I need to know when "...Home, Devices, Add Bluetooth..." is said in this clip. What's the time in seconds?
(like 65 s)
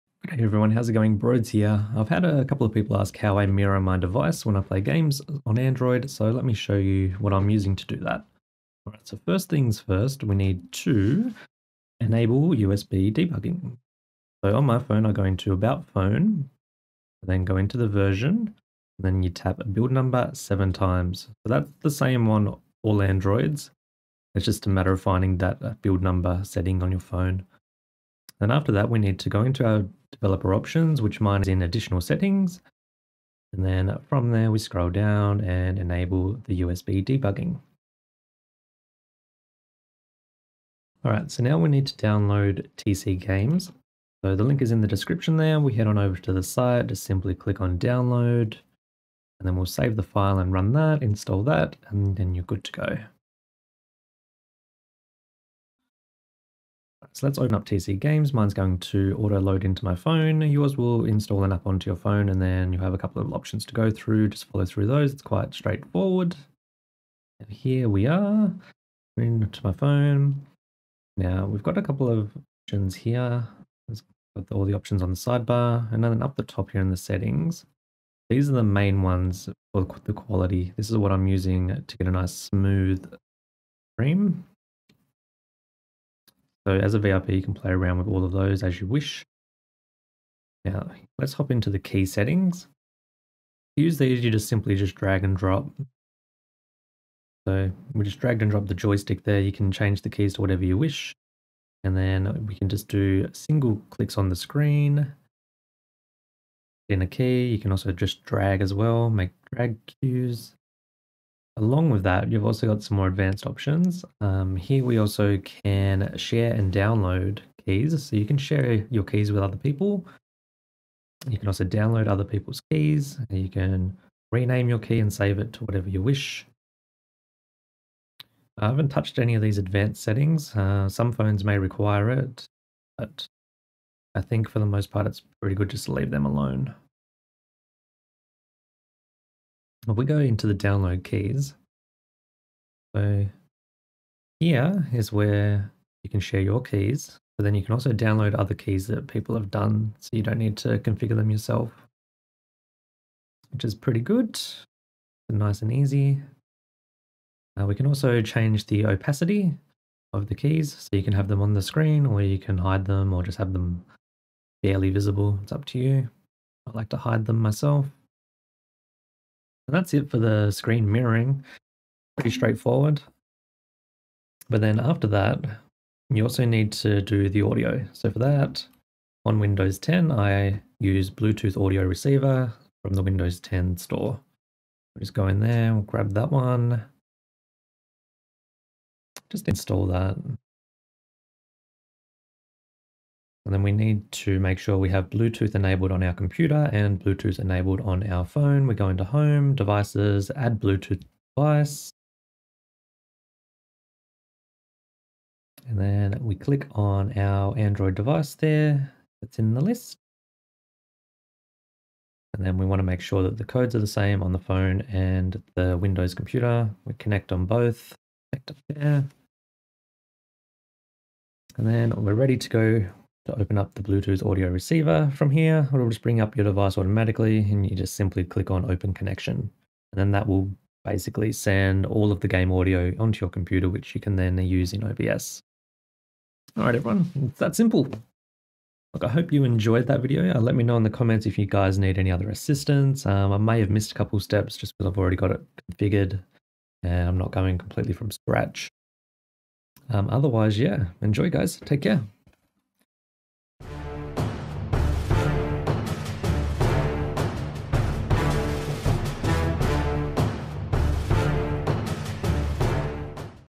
199 s.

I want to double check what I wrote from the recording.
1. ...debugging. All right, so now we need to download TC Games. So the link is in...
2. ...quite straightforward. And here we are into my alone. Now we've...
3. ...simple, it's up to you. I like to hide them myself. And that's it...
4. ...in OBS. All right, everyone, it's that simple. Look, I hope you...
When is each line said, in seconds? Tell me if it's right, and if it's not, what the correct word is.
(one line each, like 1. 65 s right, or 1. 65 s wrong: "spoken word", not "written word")
1. 37 s right
2. 65 s wrong: "phone", not "alone"
3. 164 s wrong: "visible", not "simple"
4. 234 s right.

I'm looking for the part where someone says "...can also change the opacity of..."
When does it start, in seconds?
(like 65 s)
157 s.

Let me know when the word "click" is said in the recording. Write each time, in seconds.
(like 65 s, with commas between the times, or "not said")
47 s, 103 s, 206 s, 228 s.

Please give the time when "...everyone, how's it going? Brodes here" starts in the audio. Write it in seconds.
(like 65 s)
0 s.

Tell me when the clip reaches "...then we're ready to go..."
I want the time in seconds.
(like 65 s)
221 s.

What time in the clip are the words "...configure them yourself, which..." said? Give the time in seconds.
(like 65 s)
150 s.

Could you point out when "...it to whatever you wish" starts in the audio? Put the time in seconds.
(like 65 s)
125 s.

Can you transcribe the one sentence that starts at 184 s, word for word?
We'll just go in there, we'll grab that one.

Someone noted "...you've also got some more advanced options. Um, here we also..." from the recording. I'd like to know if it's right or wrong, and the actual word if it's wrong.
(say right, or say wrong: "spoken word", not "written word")
right.